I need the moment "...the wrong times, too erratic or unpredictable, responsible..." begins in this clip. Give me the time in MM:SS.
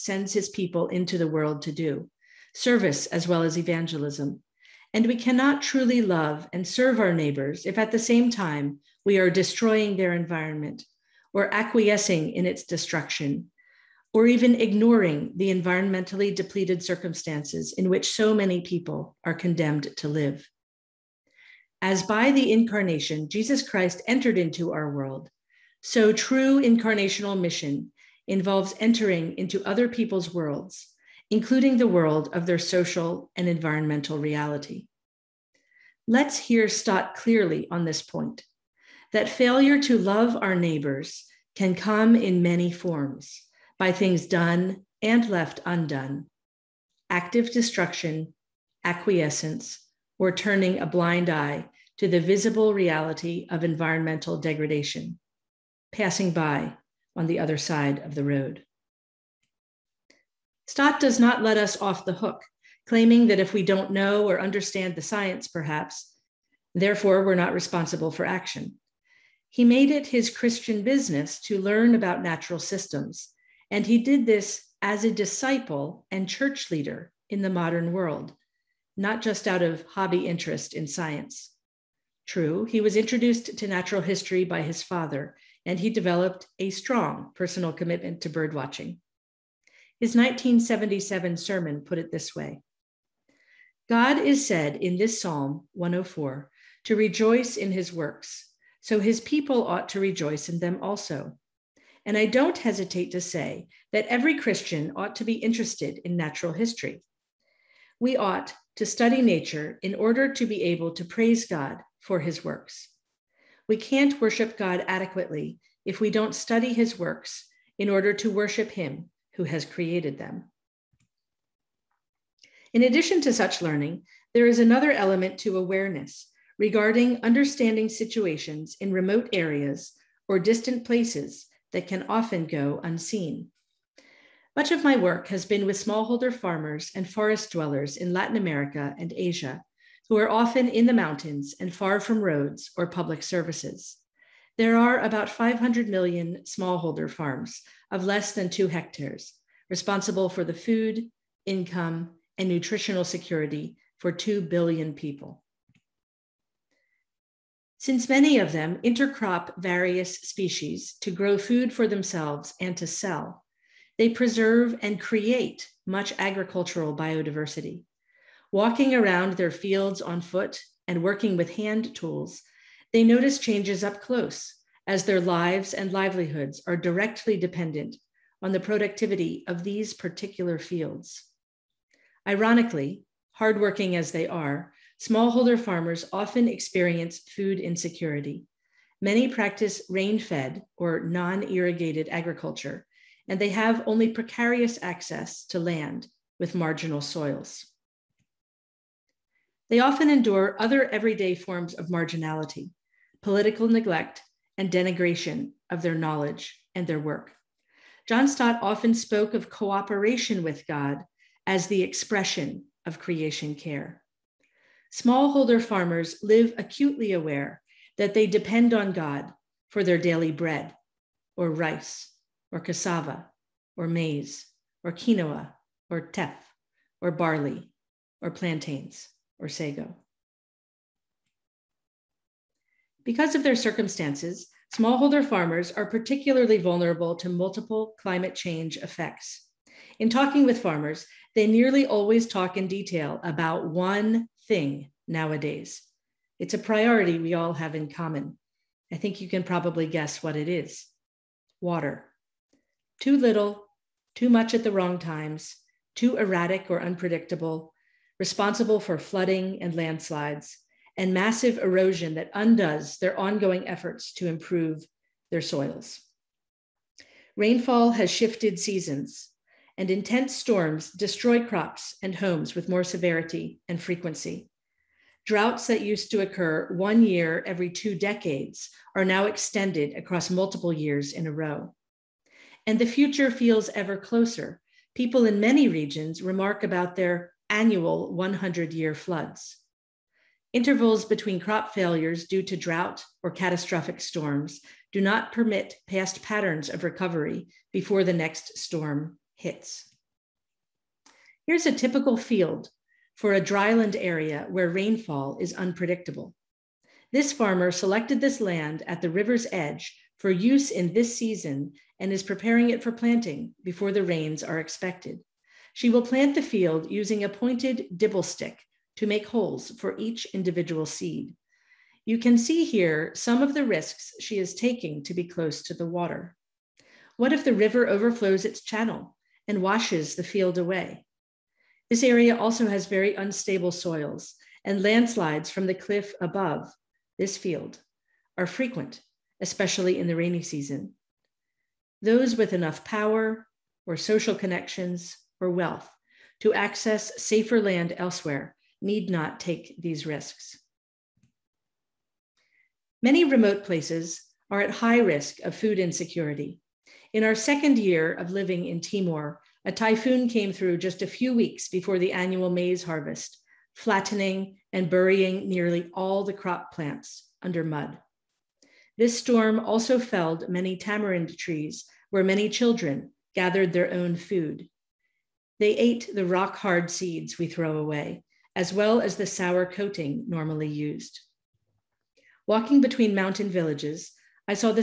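04:14.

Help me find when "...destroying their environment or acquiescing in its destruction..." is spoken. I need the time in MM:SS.
00:09.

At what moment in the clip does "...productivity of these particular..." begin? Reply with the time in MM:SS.
02:58.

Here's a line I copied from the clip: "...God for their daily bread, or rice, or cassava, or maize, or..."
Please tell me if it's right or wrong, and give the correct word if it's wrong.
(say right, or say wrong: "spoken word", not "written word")
right.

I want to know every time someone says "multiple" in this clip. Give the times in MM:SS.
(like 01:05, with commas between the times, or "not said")
03:57, 04:40.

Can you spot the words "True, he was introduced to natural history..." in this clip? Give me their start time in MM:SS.
01:22.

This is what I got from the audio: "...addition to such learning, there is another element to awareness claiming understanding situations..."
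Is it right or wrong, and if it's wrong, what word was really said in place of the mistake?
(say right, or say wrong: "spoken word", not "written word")
wrong: "regarding", not "claiming".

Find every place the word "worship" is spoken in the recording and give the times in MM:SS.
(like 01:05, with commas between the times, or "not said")
01:54, 01:58.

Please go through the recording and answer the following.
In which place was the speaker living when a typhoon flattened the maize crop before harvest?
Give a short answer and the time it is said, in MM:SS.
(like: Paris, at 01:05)
Timor, at 05:58.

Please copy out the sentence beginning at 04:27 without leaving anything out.
Rainfall has shifted seasons, and intense storms destroy crops and homes with more severity and frequency.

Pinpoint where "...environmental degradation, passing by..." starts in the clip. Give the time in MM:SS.
00:53.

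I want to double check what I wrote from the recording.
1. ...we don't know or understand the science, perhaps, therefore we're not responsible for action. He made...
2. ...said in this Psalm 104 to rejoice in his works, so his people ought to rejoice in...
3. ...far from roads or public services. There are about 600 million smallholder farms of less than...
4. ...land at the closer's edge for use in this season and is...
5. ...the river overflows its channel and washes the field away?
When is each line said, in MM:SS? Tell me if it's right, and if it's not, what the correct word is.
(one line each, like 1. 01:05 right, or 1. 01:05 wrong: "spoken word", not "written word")
1. 01:03 right
2. 01:34 right
3. 02:21 wrong: "500", not "600"
4. 05:08 wrong: "river", not "closer"
5. 05:27 right.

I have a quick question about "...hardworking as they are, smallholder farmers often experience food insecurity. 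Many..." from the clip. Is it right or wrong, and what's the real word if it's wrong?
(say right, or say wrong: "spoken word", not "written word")
right.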